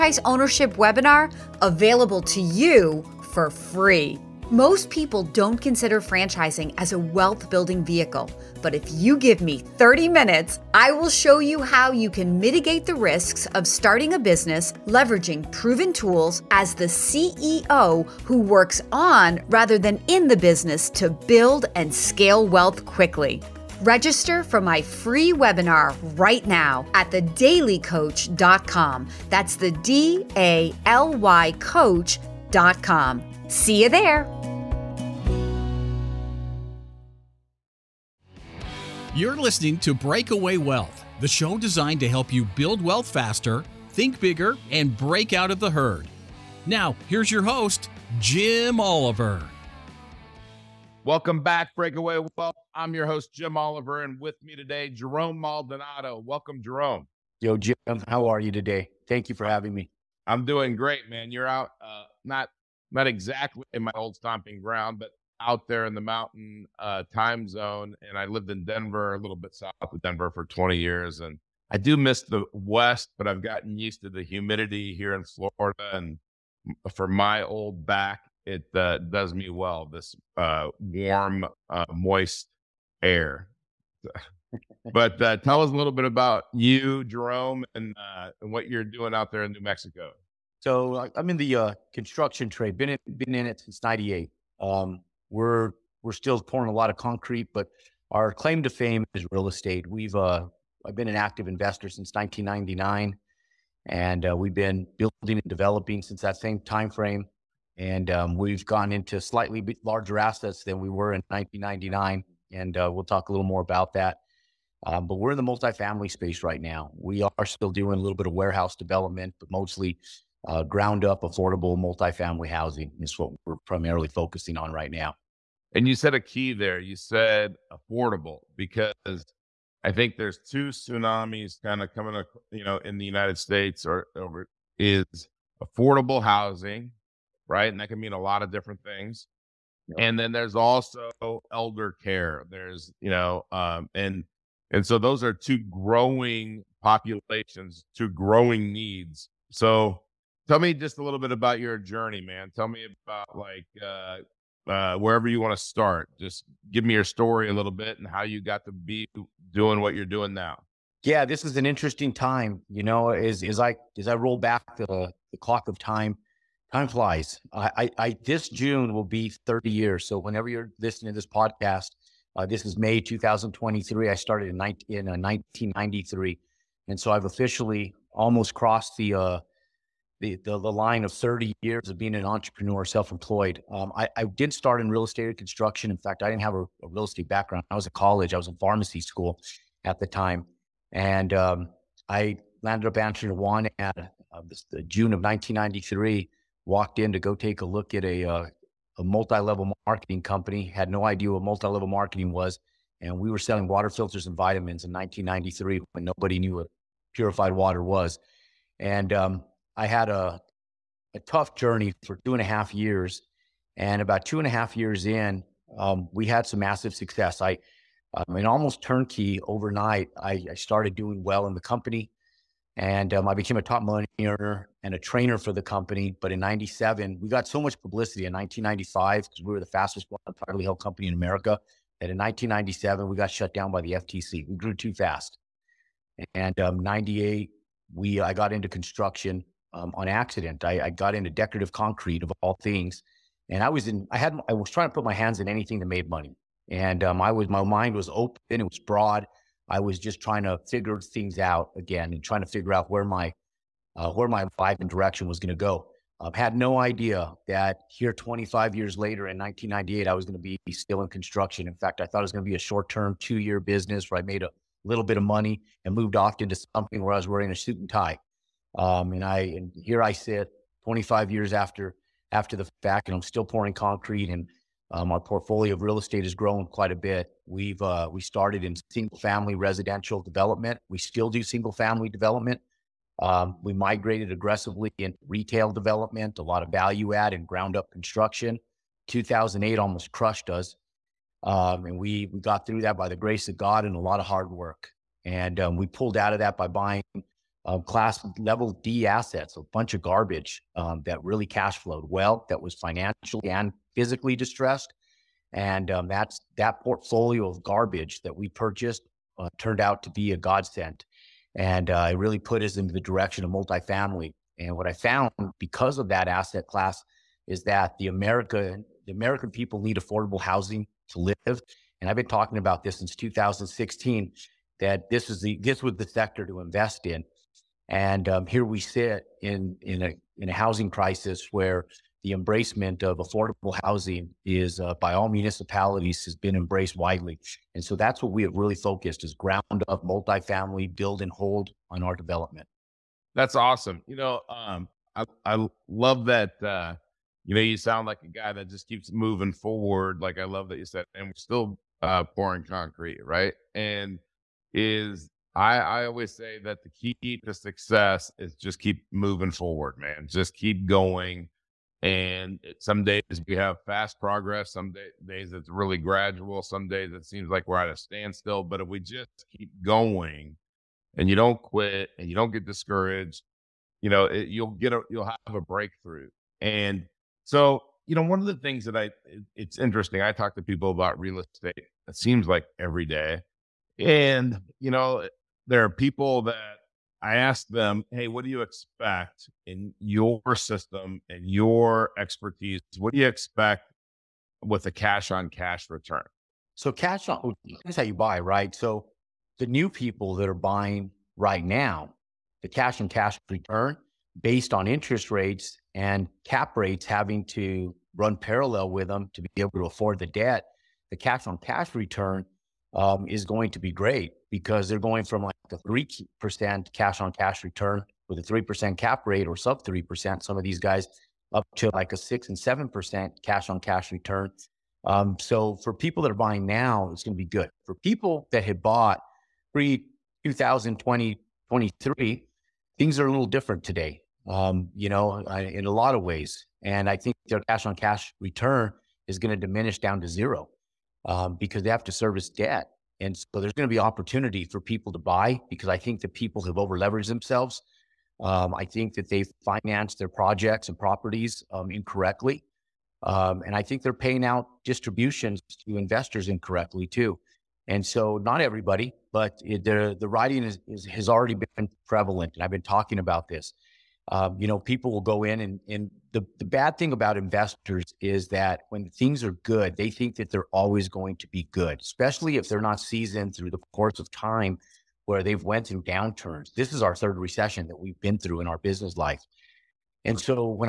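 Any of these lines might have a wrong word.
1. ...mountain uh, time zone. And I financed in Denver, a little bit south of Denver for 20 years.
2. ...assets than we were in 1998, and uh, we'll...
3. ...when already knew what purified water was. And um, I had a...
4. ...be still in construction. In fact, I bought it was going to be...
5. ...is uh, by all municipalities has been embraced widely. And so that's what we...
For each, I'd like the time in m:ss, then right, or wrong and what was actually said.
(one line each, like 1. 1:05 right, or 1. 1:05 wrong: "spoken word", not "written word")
1. 1:06 wrong: "lived", not "financed"
2. 1:50 wrong: "1999", not "1998"
3. 3:25 wrong: "nobody", not "already"
4. 4:20 wrong: "thought", not "bought"
5. 5:34 right.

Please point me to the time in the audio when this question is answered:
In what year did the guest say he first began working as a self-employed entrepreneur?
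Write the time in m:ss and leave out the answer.
2:55.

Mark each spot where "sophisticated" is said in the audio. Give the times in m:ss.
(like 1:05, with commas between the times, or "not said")
not said.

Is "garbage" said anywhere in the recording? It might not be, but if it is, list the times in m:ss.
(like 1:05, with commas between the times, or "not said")
5:00, 5:07.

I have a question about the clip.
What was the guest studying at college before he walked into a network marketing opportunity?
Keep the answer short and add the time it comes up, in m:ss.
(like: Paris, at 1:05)
Pharmacy, at 3:08.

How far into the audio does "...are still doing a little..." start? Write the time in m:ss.
1:57.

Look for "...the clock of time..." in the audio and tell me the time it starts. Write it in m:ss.
2:45.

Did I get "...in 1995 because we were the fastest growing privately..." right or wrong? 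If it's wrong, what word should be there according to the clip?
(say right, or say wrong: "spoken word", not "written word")
right.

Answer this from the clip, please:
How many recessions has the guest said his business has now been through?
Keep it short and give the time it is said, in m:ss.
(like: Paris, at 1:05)
3, at 7:57.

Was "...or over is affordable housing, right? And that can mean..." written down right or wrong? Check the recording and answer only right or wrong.
right.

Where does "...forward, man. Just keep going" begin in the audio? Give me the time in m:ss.
5:59.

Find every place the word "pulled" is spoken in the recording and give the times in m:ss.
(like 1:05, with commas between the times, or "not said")
4:55.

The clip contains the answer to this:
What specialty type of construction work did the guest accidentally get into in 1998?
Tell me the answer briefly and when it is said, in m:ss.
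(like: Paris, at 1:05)
Decorative concrete, at 4:01.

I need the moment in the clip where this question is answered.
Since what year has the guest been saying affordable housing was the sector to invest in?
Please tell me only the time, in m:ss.
5:23.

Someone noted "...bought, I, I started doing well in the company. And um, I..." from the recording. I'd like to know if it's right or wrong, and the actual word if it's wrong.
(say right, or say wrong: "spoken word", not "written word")
wrong: "overnight", not "bought".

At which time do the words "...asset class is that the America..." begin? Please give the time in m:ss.
5:16.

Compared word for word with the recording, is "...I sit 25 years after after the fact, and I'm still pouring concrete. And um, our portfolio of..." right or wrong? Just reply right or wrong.
right.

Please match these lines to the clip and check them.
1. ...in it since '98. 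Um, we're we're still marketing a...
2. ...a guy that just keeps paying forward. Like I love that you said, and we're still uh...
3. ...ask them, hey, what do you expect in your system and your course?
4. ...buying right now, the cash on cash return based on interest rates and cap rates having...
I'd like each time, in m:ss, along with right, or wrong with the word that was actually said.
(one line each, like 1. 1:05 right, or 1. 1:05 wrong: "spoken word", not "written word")
1. 1:33 wrong: "pouring", not "marketing"
2. 5:48 wrong: "moving", not "paying"
3. 6:27 wrong: "expertise", not "course"
4. 6:40 right.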